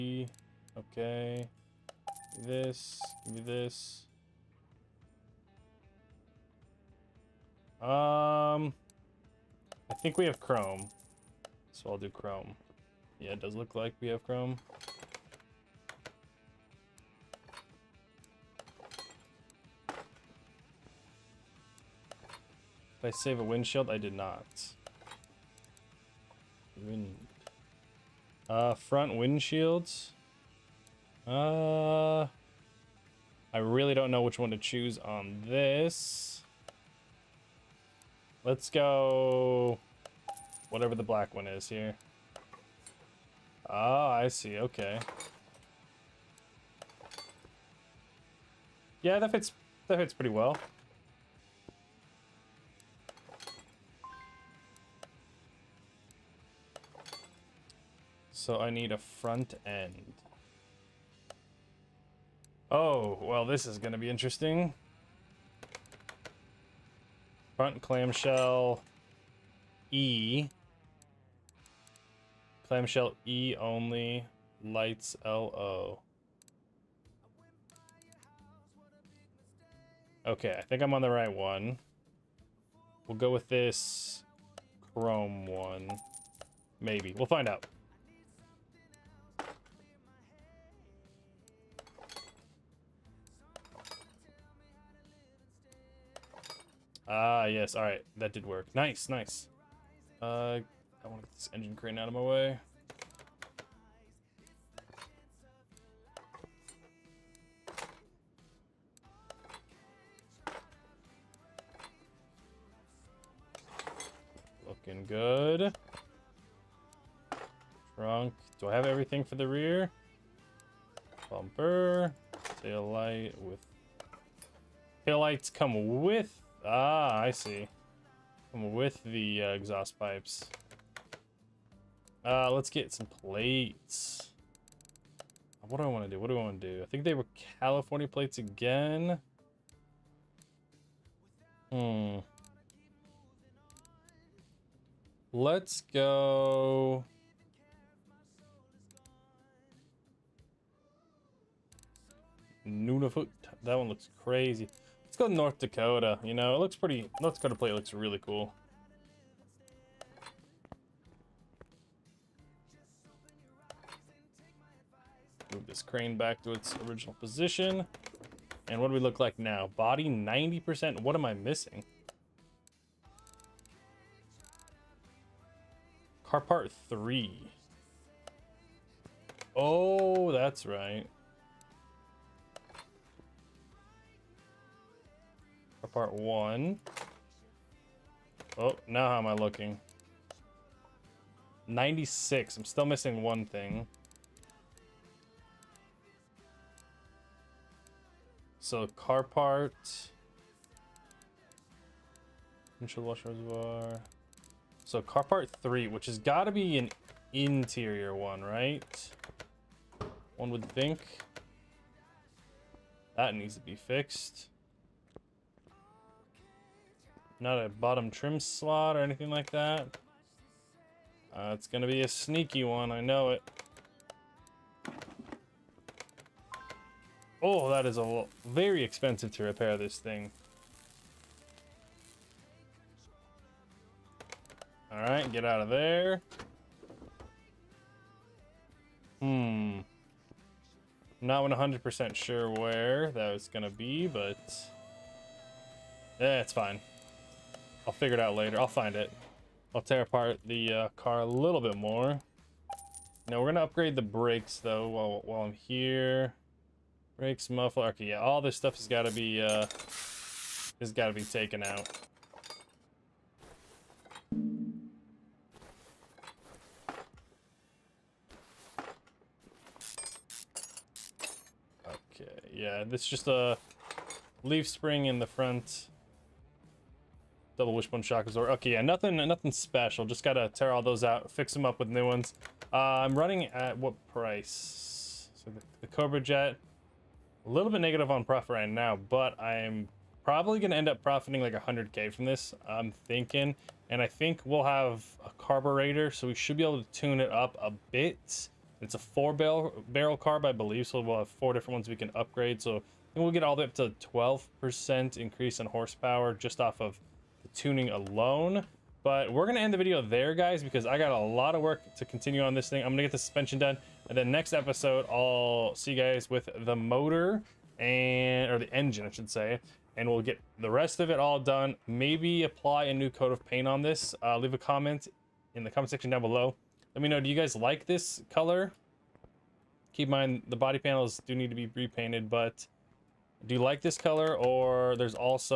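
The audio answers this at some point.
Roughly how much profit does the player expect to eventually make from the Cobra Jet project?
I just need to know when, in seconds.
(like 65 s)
291 s.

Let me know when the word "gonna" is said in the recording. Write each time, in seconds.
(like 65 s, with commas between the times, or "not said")
253 s, 290 s.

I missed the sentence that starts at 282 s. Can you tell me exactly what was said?
Uh, I'm running at what price?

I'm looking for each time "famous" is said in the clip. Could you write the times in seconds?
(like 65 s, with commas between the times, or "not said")
not said.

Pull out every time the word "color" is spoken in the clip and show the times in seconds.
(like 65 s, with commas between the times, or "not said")
328 s, 333 s.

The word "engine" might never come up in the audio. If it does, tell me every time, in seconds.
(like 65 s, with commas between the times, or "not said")
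101 s, 318 s.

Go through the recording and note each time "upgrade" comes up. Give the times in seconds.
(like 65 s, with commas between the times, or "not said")
253 s, 302 s.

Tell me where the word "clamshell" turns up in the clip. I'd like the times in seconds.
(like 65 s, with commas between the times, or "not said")
67 s, 72 s.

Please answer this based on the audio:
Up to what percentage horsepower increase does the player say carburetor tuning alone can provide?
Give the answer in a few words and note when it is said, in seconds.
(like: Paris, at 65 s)
12%, at 304 s.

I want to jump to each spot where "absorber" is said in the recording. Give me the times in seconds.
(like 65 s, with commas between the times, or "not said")
278 s.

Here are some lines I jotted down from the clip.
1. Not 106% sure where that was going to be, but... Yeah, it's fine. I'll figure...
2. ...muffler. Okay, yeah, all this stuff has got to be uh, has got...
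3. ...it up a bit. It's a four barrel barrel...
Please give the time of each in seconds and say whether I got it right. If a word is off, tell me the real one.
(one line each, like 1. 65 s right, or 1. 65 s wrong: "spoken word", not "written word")
1. 241 s wrong: "100", not "106"
2. 257 s right
3. 297 s right.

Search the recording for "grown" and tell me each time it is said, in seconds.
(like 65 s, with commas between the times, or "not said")
not said.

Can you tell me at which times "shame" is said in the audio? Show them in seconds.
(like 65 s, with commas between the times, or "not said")
not said.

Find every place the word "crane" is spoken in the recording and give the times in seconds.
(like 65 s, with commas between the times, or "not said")
101 s, 165 s.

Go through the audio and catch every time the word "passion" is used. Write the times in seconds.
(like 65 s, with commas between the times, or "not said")
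not said.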